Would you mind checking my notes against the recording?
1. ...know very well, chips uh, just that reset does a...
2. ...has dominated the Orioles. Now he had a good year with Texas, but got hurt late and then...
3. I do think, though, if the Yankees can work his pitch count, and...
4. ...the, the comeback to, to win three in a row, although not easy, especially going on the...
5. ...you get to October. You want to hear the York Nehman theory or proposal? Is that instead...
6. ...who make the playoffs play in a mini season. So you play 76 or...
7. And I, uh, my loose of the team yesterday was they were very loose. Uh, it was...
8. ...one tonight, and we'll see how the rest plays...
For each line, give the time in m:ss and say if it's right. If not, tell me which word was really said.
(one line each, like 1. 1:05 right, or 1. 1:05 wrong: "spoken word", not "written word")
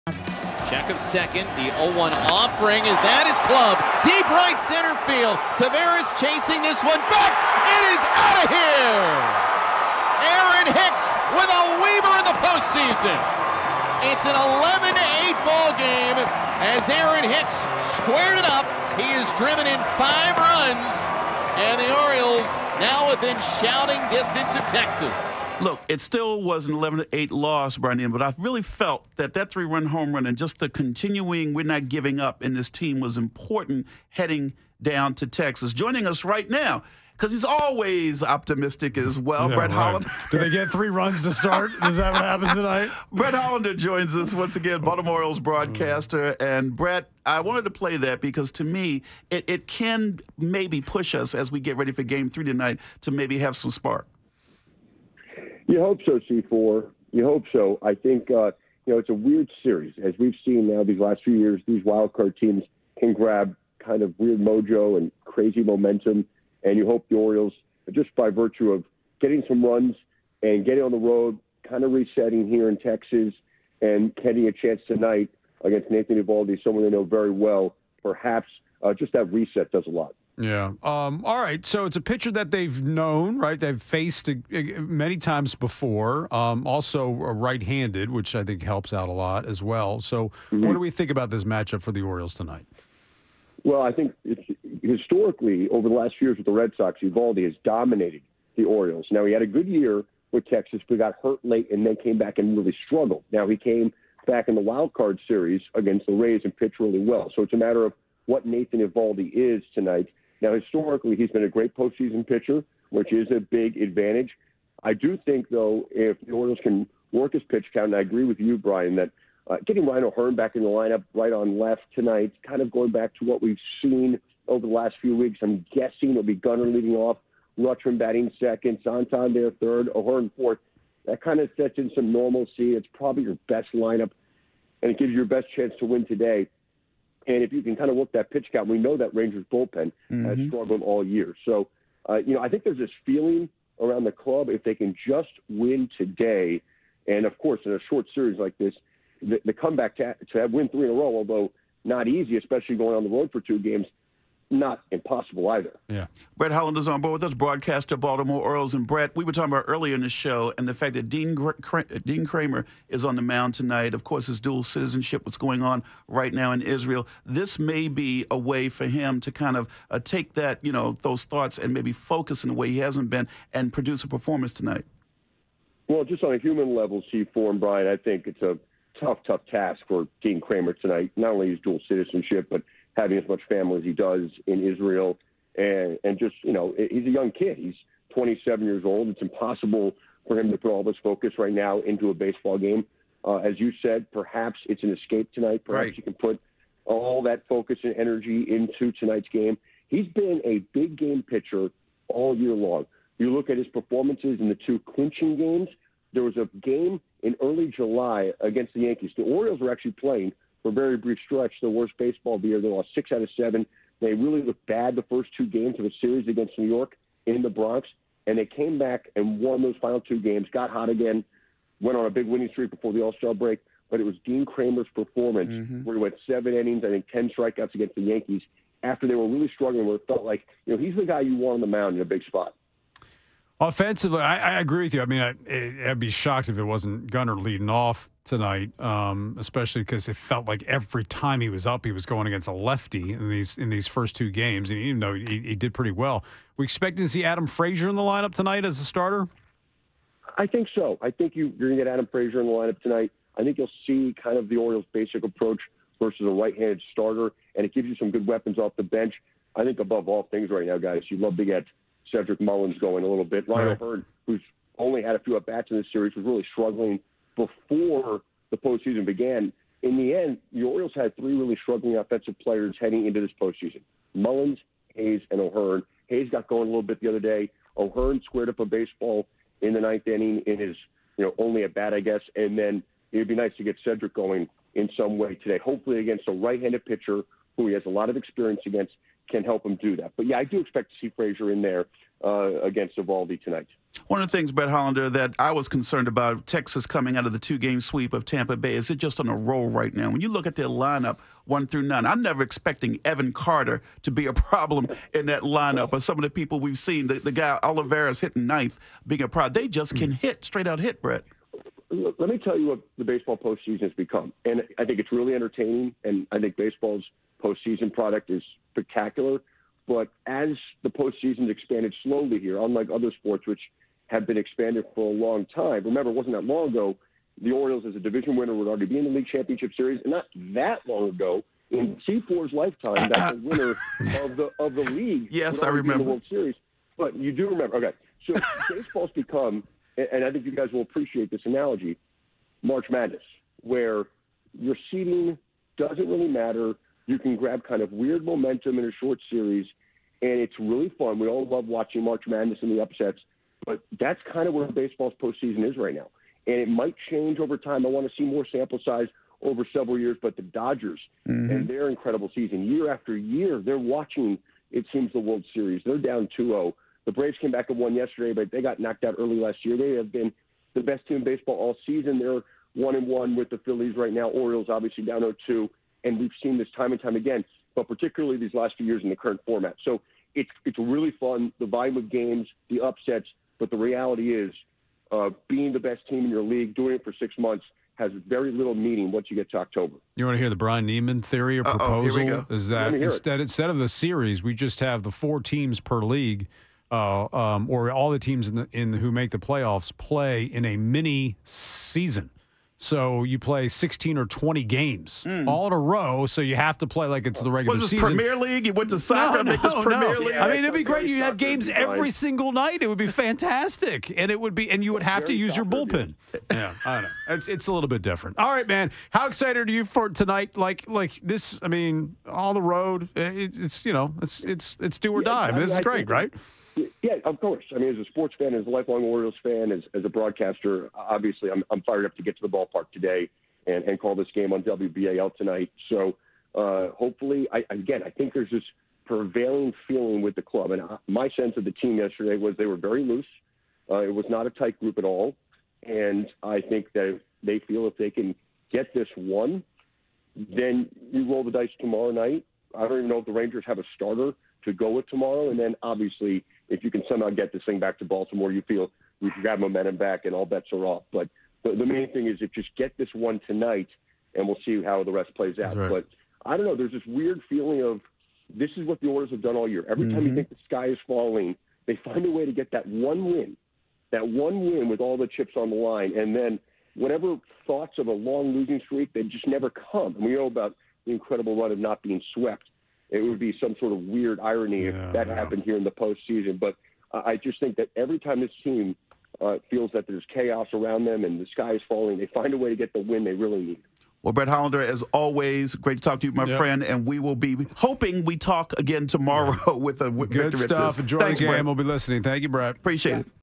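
1. 1:16 wrong: "perhaps", not "chips"
2. 1:37 right
3. 1:54 wrong: "Orioles", not "Yankees"
4. 2:29 right
5. 6:29 wrong: "Bryan", not "York"
6. 6:38 wrong: "16", not "76"
7. 7:20 wrong: "sense", not "loose"
8. 7:43 right.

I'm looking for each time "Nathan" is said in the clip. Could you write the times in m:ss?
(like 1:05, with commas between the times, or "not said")
1:15, 1:48.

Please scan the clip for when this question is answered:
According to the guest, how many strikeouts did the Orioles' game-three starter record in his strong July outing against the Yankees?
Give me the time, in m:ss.
3:47.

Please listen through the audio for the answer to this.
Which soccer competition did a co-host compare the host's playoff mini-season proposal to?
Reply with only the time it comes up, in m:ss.
6:47.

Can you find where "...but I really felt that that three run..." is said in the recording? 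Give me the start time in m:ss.
0:28.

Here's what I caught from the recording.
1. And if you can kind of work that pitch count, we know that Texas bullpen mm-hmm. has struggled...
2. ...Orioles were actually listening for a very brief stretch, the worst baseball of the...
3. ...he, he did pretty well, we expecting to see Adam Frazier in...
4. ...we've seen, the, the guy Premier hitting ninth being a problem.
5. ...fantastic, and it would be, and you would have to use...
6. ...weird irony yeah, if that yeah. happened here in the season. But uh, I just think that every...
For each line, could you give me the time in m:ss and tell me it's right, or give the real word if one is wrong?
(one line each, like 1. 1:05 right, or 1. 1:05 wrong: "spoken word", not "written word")
1. 2:17 wrong: "Rangers", not "Texas"
2. 3:29 wrong: "playing", not "listening"
3. 4:05 right
4. 5:06 wrong: "Oliveras", not "Premier"
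5. 6:53 right
6. 8:03 wrong: "postseason", not "season".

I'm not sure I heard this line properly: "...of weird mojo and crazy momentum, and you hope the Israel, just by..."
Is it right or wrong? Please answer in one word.
wrong.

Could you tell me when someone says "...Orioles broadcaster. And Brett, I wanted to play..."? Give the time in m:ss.
0:45.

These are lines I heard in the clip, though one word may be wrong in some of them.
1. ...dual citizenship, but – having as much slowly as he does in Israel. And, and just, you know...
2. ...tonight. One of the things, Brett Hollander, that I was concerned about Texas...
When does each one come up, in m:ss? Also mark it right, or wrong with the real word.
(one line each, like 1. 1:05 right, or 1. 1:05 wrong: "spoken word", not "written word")
1. 3:01 wrong: "family", not "slowly"
2. 4:53 right.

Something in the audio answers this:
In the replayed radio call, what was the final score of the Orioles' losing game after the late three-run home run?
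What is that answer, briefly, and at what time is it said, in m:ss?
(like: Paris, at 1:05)
11-8, at 0:14.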